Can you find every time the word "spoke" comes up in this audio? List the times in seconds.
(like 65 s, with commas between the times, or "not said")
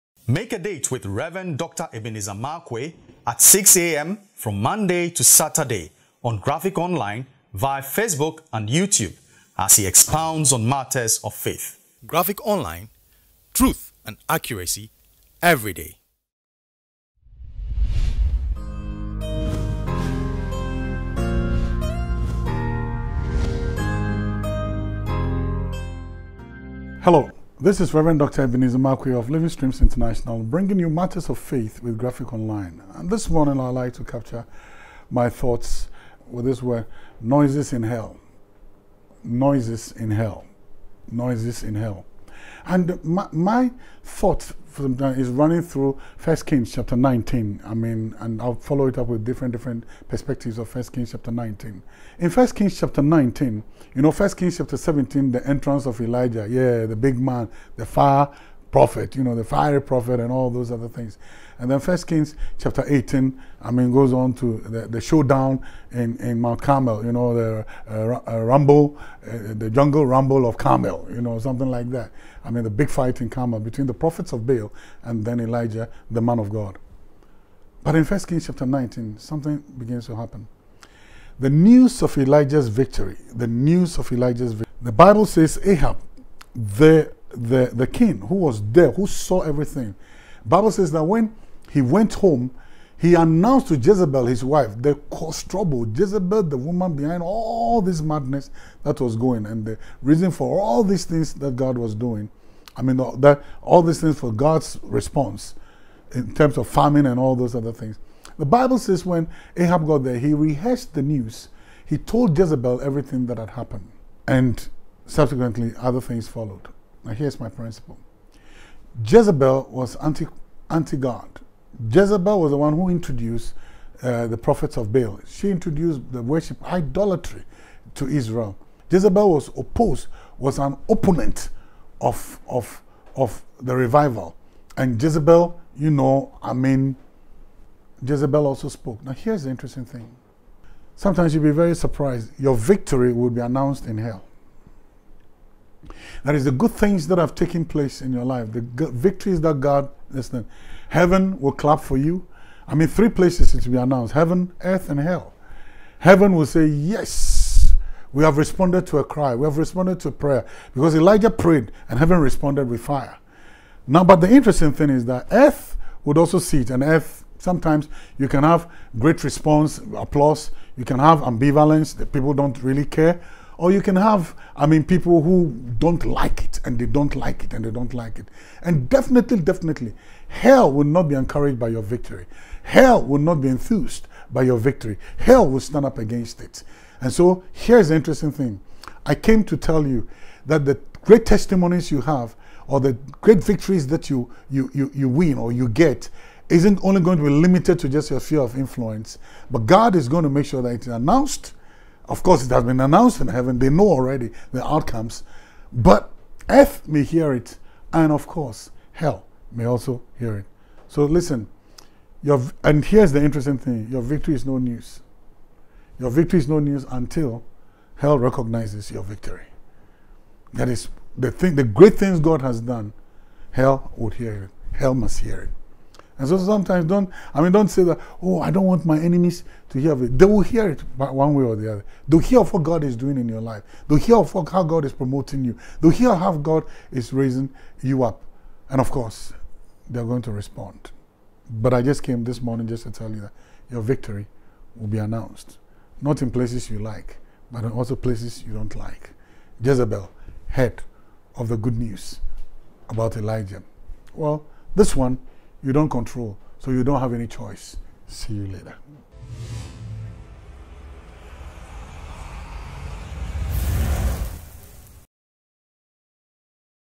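138 s.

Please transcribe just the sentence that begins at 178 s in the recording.
And definitely, definitely, hell will not be encouraged by your victory.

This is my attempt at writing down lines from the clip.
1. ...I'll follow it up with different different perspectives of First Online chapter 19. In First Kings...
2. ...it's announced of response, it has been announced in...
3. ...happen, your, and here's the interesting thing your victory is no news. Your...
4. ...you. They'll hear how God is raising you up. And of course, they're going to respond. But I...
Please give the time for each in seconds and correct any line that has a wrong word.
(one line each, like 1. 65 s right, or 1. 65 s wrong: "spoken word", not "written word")
1. 48 s wrong: "Kings", not "Online"
2. 200 s wrong: "course", not "response"
3. 211 s wrong: "listen", not "happen"
4. 235 s right.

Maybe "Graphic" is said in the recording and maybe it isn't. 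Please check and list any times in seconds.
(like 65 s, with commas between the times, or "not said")
6 s, 12 s, 31 s.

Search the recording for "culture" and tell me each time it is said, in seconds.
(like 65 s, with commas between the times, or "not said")
not said.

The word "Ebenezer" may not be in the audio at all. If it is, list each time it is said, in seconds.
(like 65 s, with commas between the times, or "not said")
1 s, 28 s.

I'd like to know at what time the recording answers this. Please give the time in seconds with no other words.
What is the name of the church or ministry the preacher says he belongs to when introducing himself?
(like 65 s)
29 s.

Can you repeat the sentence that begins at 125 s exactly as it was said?
She introduced the worship idolatry to Israel.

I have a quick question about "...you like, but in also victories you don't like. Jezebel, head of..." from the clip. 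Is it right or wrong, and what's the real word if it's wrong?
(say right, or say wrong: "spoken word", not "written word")
wrong: "places", not "victories".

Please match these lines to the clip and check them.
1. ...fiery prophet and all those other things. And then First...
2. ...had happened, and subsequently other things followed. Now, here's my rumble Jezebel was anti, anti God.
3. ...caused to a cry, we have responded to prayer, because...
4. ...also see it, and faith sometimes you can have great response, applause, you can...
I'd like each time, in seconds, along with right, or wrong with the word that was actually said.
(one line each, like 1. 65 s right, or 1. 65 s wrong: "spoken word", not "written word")
1. 59 s right
2. 113 s wrong: "principle", not "rumble"
3. 158 s wrong: "responded", not "caused"
4. 166 s wrong: "earth", not "faith".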